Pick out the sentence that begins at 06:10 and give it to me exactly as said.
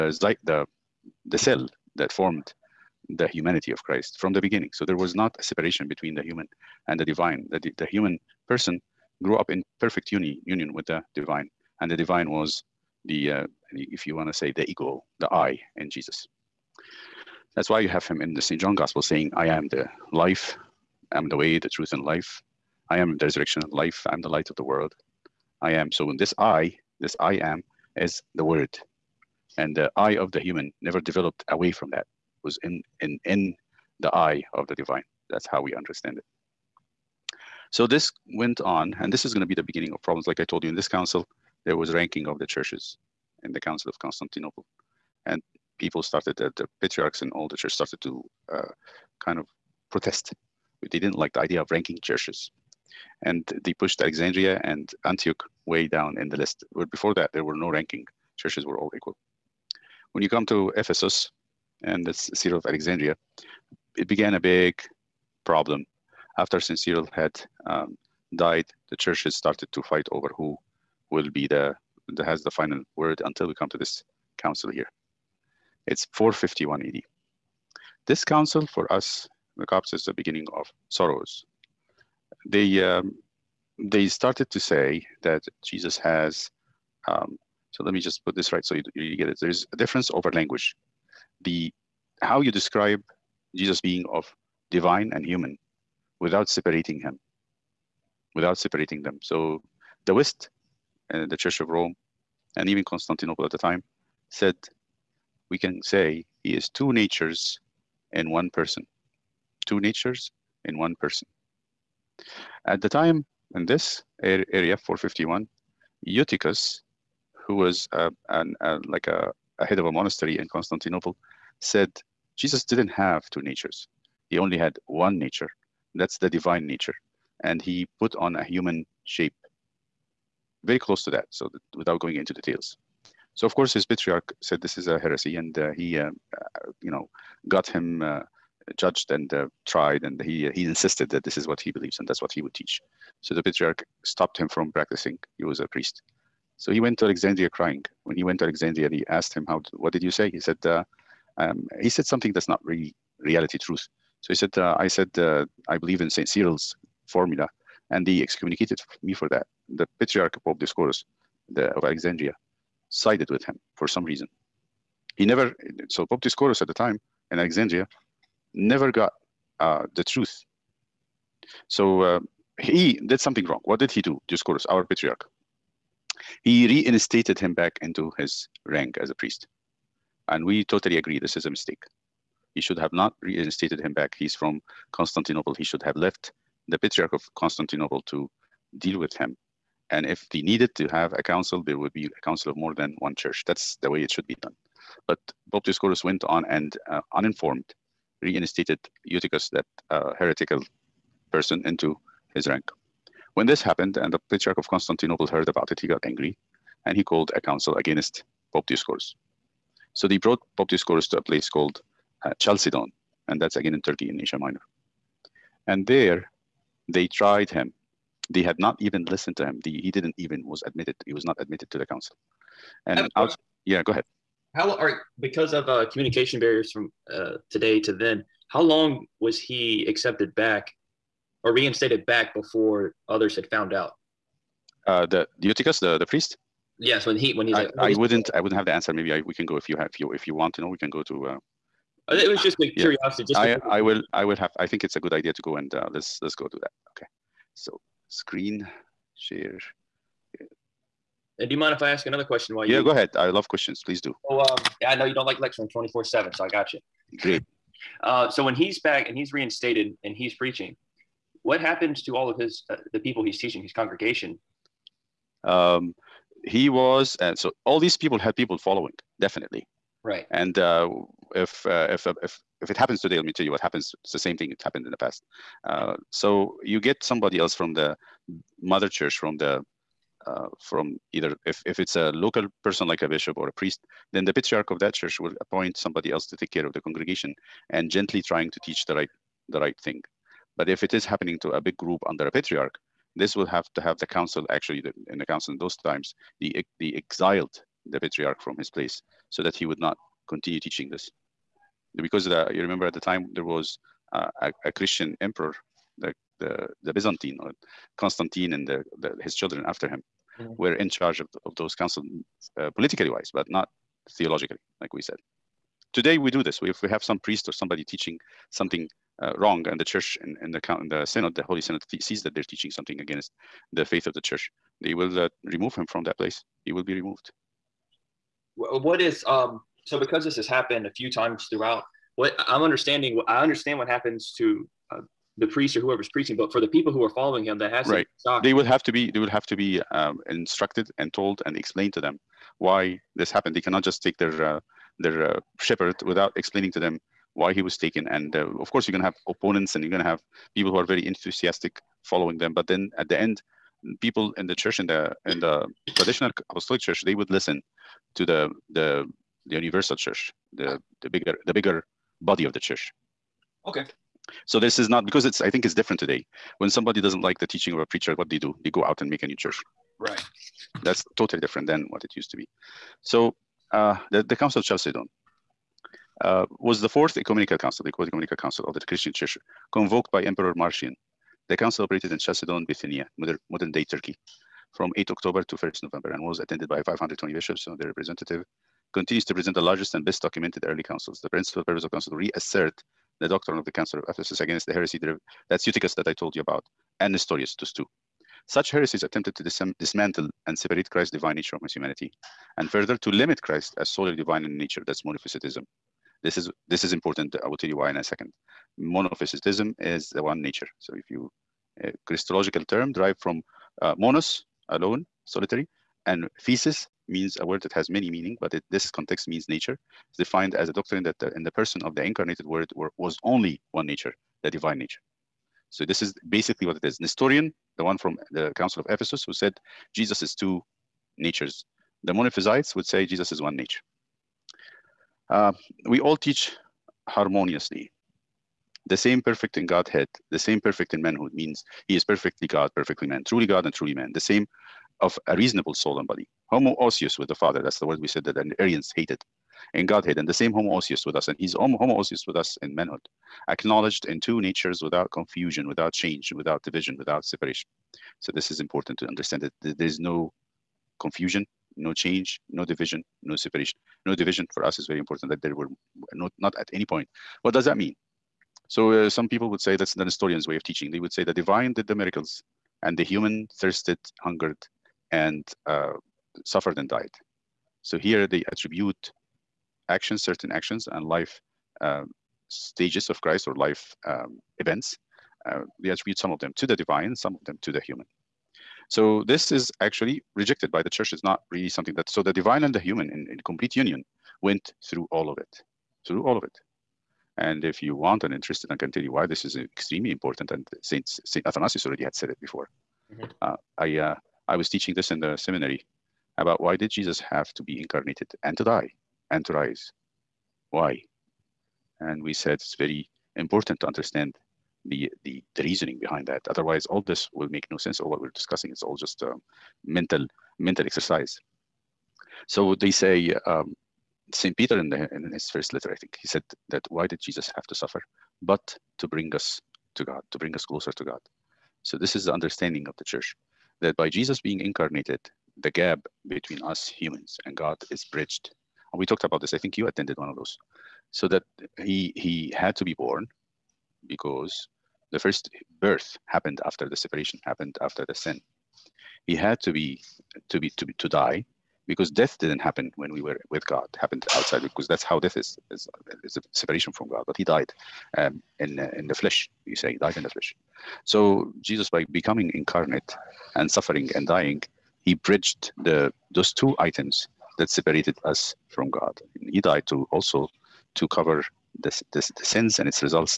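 That's totally different than what it used to be.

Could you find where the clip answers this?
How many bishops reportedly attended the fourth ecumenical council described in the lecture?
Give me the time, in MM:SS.
06:26.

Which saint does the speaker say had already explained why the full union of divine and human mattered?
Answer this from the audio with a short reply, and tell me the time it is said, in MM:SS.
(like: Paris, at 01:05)
Saint Athanasius, at 08:21.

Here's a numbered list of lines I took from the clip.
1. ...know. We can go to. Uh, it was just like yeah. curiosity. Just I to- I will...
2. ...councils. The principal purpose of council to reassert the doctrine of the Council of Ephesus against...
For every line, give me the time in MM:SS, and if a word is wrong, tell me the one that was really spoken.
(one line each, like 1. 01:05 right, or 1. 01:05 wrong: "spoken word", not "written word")
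1. 04:00 right
2. 06:30 right.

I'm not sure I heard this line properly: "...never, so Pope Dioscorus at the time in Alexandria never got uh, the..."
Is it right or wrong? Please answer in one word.
right.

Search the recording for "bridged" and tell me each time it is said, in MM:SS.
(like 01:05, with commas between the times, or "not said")
08:58, 09:25.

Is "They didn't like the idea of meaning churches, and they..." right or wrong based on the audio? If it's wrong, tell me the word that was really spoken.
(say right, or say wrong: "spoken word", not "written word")
wrong: "ranking", not "meaning".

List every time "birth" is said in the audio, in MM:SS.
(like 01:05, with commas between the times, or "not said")
09:05.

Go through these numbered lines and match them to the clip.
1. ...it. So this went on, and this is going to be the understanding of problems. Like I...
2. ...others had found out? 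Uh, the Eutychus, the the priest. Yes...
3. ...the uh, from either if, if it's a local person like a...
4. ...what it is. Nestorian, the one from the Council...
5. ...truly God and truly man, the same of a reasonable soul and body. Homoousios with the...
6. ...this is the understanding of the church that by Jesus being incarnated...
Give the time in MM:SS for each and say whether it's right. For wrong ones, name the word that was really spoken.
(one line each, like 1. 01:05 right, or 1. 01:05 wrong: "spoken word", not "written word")
1. 00:36 wrong: "beginning", not "understanding"
2. 03:53 right
3. 04:39 right
4. 07:06 right
5. 07:23 right
6. 08:51 right.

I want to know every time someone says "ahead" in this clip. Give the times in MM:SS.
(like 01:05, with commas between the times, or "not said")
03:43, 04:12.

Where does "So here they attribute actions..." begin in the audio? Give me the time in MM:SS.
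07:57.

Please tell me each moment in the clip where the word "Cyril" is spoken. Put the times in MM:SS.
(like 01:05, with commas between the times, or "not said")
01:06, 02:36.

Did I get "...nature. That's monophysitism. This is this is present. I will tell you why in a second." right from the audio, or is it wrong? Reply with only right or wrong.
wrong.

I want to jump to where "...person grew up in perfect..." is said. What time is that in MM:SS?
00:08.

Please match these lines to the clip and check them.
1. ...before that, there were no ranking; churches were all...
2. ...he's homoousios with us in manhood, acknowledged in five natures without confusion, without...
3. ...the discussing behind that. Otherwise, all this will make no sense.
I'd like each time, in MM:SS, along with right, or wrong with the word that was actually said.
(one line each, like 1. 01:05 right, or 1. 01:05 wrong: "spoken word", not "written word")
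1. 00:56 right
2. 07:31 wrong: "two", not "five"
3. 08:35 wrong: "reasoning", not "discussing".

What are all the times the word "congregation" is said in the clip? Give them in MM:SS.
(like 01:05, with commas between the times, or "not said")
04:23, 04:46.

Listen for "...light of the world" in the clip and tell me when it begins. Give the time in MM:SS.
00:24.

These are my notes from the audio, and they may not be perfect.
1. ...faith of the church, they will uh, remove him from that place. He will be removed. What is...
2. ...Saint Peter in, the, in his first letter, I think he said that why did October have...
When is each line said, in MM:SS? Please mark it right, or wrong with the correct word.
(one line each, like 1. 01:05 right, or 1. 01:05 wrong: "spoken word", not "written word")
1. 05:23 right
2. 08:44 wrong: "Jesus", not "October".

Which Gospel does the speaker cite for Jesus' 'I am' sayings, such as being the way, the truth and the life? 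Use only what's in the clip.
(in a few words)
St. John Gospel.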